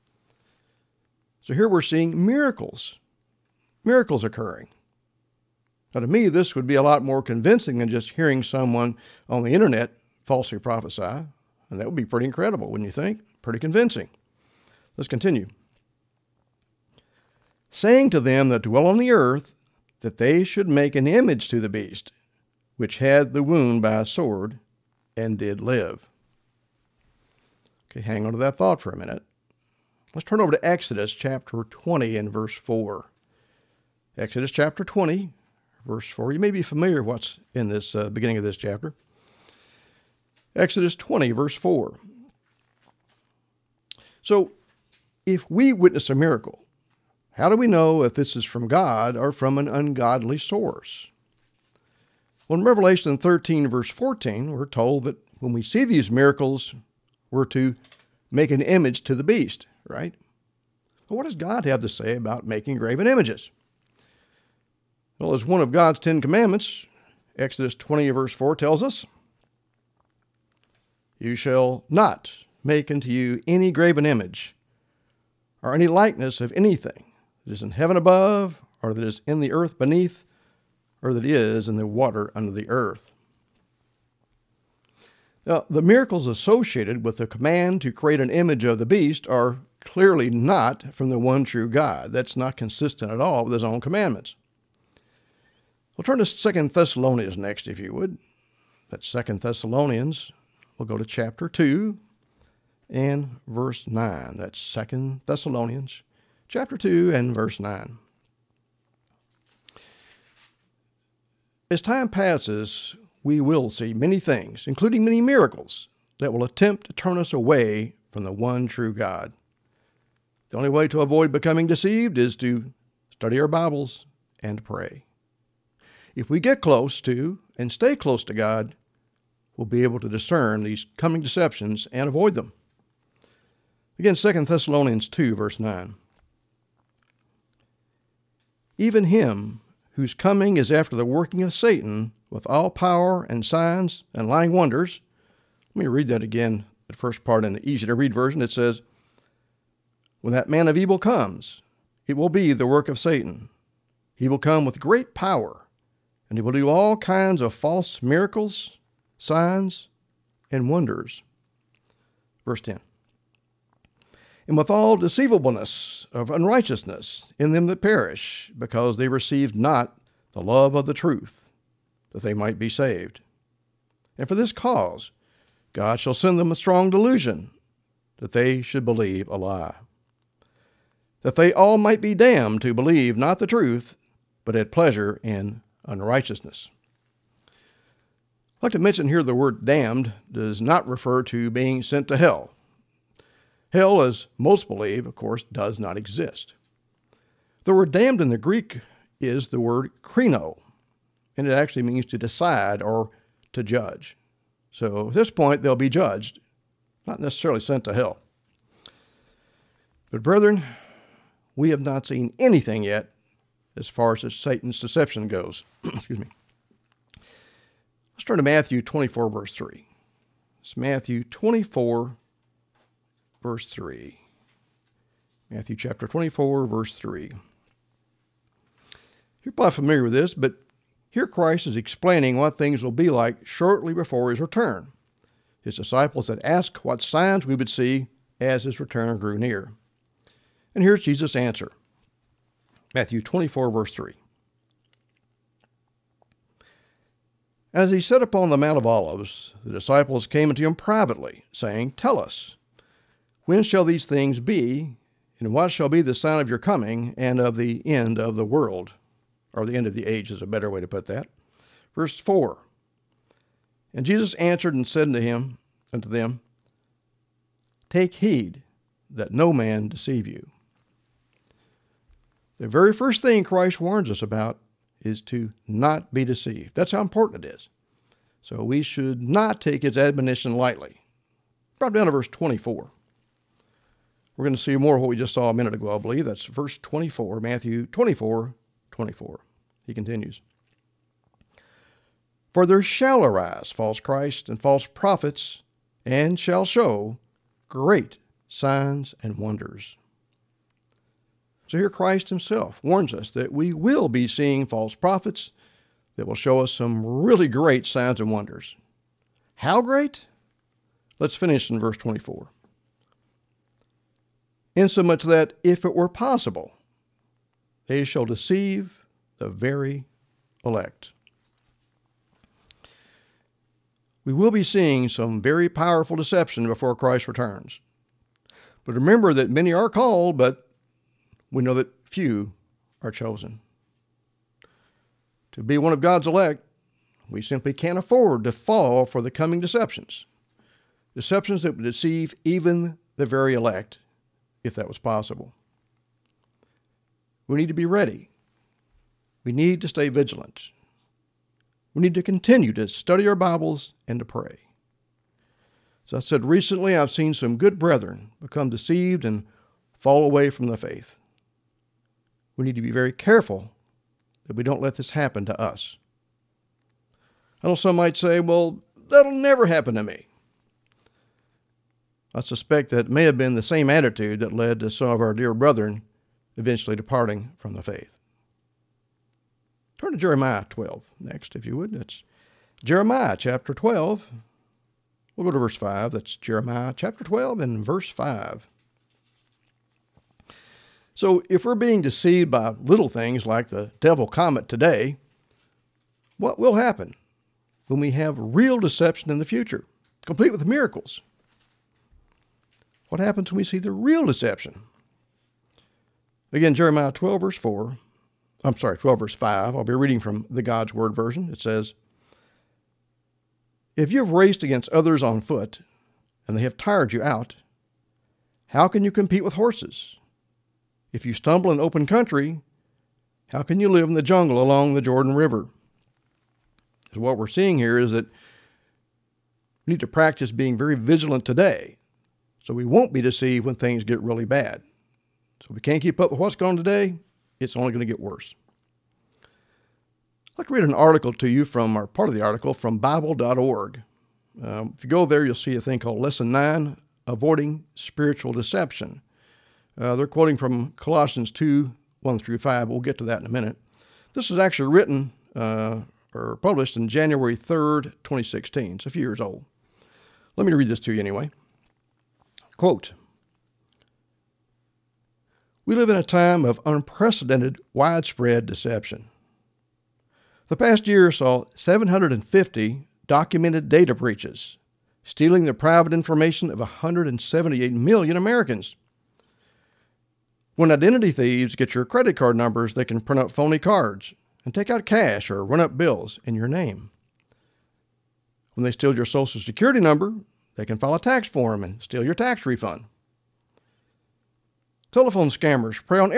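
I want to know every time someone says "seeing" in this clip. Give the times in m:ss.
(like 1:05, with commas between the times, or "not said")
0:01, 5:04, 5:24, 7:07.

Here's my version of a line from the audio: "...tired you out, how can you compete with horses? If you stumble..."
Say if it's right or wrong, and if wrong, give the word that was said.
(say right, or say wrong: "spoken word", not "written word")
right.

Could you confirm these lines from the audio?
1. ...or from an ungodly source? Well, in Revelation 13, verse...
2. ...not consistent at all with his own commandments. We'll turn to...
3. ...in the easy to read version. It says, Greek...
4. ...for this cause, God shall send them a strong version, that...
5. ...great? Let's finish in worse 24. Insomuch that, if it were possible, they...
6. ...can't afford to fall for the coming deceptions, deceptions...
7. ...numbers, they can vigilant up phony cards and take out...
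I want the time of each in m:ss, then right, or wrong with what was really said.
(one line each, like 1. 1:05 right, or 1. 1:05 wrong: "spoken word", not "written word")
1. 0:49 right
2. 1:32 right
3. 2:27 wrong: "When", not "Greek"
4. 2:54 wrong: "delusion", not "version"
5. 5:09 wrong: "verse", not "worse"
6. 5:37 right
7. 8:02 wrong: "print", not "vigilant".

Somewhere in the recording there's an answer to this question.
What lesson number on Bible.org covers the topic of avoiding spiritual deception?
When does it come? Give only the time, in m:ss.
7:26.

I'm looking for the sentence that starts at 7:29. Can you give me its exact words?
Uh, they're quoting from Colossians 2 1 through 5.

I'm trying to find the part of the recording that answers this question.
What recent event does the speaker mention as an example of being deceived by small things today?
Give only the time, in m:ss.
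6:33.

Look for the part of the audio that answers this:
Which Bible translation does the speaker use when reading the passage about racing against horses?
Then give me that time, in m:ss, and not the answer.
6:50.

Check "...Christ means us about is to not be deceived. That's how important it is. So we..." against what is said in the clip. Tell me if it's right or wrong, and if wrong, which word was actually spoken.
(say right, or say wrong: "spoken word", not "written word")
wrong: "warns", not "means".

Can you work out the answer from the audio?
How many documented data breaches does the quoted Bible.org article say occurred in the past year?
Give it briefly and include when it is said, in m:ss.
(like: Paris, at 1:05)
750, at 7:51.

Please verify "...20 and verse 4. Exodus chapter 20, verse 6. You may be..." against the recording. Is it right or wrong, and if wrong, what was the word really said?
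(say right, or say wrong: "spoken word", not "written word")
wrong: "4", not "6".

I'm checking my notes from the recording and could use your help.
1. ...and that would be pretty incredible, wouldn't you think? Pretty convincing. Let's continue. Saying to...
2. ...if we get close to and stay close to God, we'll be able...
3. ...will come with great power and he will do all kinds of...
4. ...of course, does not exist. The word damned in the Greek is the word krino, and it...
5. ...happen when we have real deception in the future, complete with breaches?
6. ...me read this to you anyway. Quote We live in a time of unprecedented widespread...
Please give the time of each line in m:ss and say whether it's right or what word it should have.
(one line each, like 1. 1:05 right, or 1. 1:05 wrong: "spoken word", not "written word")
1. 0:11 right
2. 2:06 right
3. 2:34 right
4. 3:15 right
5. 6:36 wrong: "miracles", not "breaches"
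6. 7:40 right.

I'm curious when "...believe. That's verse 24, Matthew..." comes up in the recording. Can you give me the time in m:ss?
4:45.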